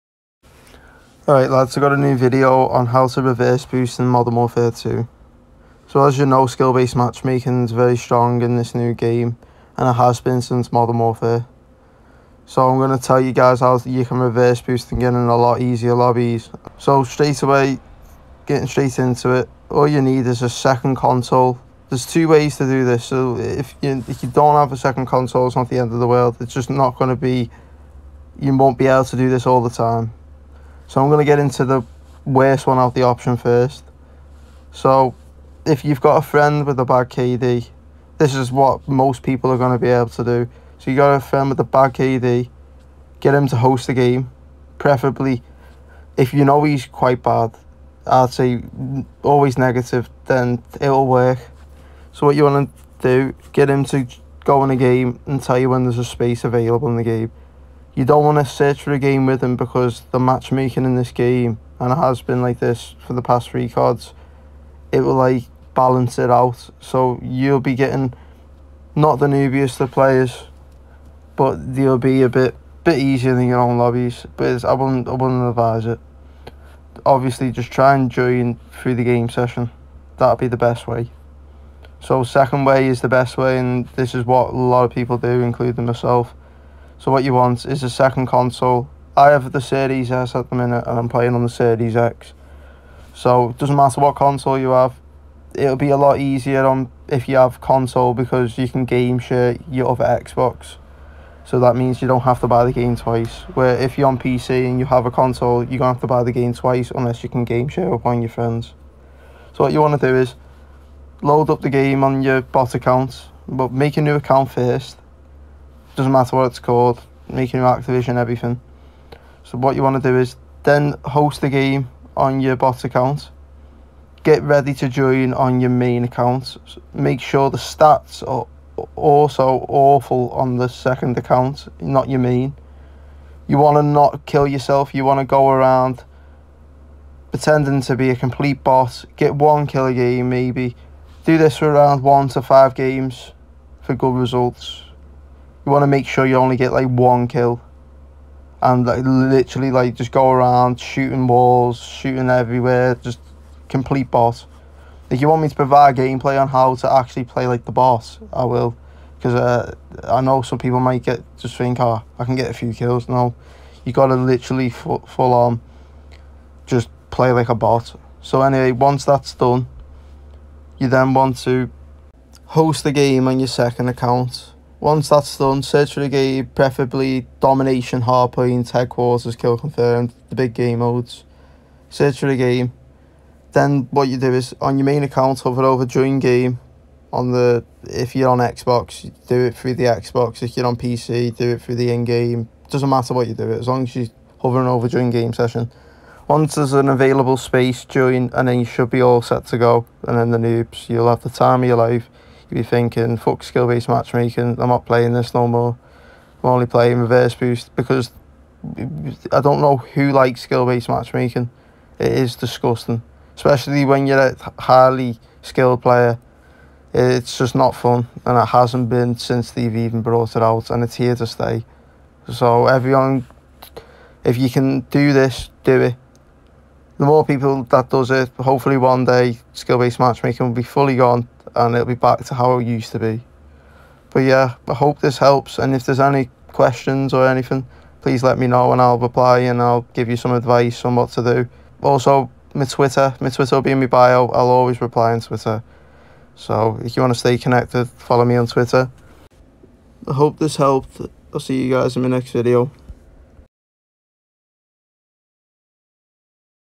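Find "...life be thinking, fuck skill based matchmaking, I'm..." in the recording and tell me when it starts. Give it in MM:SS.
03:21.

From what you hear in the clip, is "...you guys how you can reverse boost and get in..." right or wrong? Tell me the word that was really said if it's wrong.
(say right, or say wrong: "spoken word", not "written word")
right.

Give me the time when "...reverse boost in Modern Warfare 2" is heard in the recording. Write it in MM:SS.
00:03.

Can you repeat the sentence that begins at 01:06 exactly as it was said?
So you'll be getting not the newbiest of players, but they'll be a bit bit easier than your own lobbies.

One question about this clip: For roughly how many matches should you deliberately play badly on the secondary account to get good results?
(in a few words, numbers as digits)
1 to 5.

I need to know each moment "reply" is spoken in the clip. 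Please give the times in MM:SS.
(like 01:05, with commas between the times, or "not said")
03:58, 04:04.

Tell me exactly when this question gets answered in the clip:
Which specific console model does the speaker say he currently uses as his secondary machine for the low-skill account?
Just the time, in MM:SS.
01:29.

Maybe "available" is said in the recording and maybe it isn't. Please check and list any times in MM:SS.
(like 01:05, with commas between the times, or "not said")
00:56, 03:16.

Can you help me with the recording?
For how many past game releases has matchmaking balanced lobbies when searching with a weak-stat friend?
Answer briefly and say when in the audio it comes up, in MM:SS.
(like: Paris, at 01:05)
3, at 01:03.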